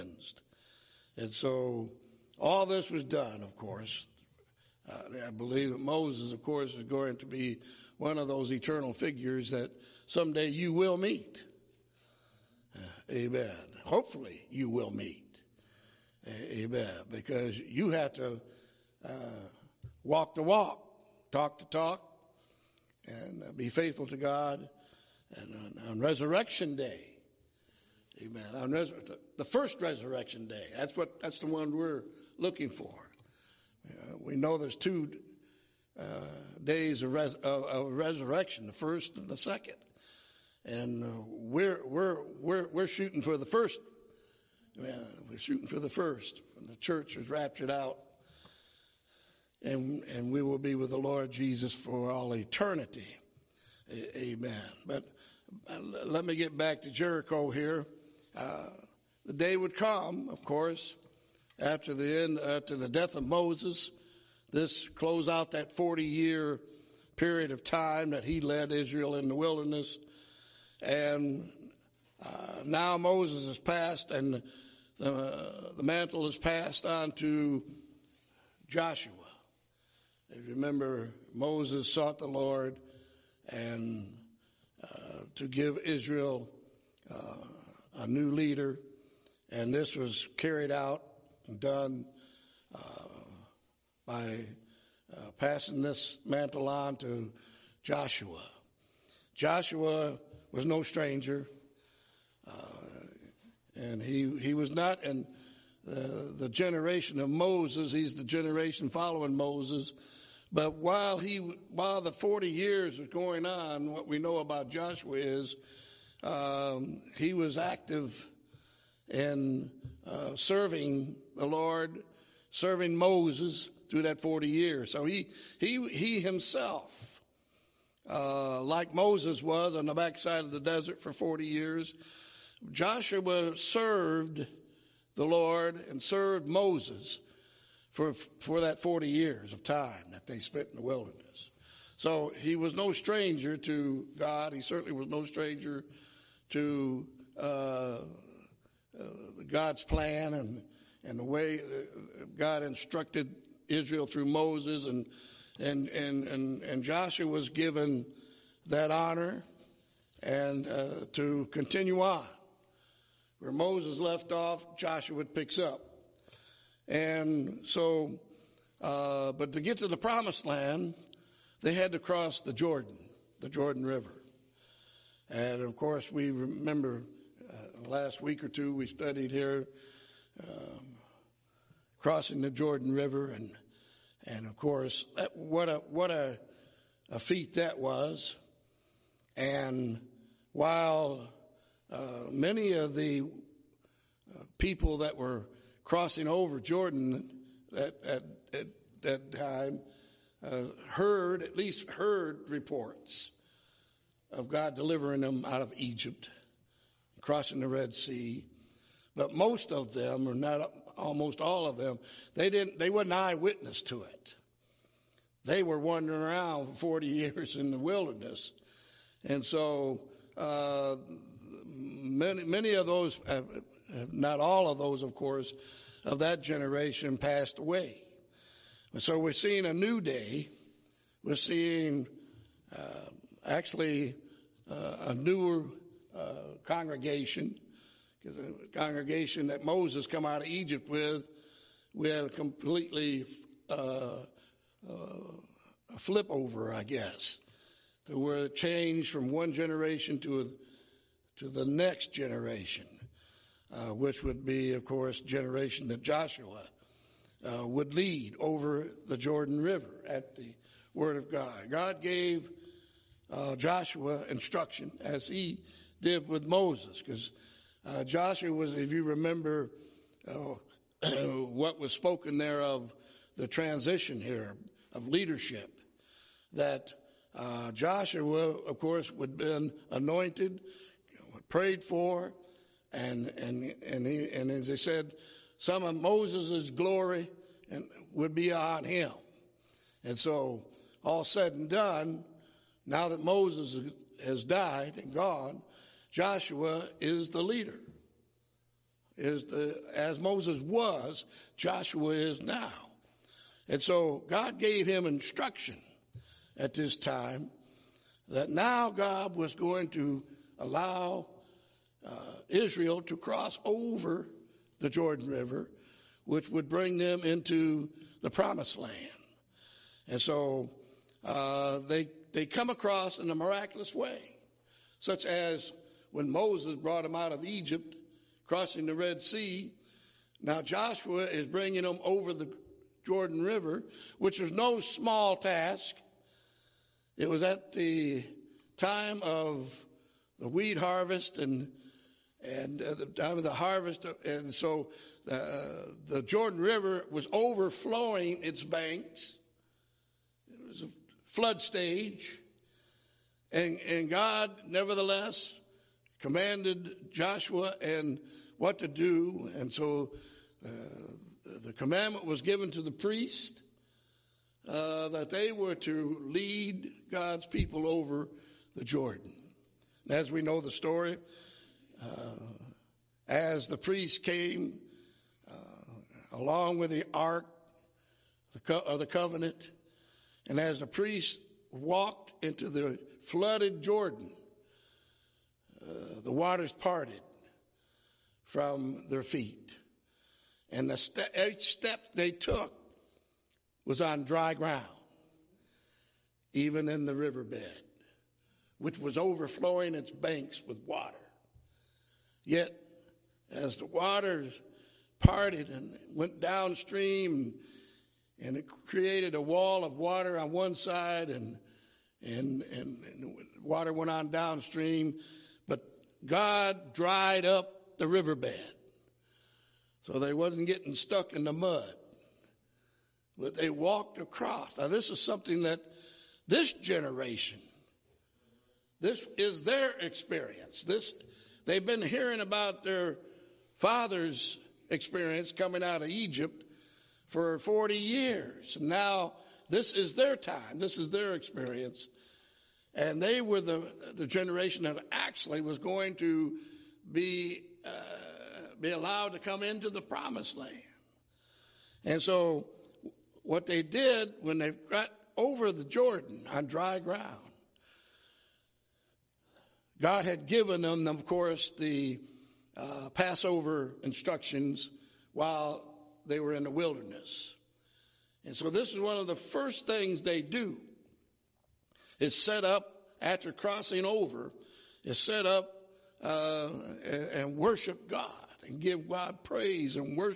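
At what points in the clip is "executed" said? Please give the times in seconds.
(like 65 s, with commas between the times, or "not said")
not said.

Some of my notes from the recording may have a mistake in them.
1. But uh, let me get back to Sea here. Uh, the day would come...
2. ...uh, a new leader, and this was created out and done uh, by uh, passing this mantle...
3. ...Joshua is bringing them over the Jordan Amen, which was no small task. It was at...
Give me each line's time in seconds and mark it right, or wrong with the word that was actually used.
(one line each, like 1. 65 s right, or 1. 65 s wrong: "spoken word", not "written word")
1. 54 s wrong: "Jericho", not "Sea"
2. 87 s wrong: "carried", not "created"
3. 330 s wrong: "River", not "Amen".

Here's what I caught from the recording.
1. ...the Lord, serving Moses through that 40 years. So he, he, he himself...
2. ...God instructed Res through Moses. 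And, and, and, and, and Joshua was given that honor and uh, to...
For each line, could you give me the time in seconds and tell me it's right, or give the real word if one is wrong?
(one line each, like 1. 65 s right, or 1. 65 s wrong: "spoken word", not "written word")
1. 121 s right
2. 152 s wrong: "Israel", not "Res".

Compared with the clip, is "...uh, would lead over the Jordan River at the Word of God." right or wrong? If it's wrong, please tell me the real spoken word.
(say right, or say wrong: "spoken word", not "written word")
right.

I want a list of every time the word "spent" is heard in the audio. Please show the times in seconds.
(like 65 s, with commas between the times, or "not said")
140 s.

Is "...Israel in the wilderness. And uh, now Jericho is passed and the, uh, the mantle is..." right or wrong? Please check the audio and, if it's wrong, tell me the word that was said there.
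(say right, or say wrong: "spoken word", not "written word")
wrong: "Moses", not "Jericho".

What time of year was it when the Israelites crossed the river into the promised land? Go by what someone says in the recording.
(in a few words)
Wheat harvest.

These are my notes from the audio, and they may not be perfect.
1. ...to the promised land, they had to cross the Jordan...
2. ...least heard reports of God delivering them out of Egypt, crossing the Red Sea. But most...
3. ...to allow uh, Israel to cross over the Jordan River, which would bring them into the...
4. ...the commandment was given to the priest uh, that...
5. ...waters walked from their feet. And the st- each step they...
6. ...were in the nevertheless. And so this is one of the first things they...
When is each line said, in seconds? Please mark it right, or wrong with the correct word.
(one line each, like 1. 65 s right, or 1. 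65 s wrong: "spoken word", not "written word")
1. 169 s right
2. 201 s right
3. 309 s right
4. 361 s right
5. 386 s wrong: "parted", not "walked"
6. 466 s wrong: "wilderness", not "nevertheless".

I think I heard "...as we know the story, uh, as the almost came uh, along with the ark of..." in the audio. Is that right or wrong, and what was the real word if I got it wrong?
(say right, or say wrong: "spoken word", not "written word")
wrong: "priest", not "almost".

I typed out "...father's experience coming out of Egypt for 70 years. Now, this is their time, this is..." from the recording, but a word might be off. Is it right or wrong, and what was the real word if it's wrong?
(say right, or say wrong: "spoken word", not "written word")
wrong: "40", not "70".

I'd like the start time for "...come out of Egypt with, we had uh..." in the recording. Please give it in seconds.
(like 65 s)
240 s.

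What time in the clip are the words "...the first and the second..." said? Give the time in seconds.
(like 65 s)
38 s.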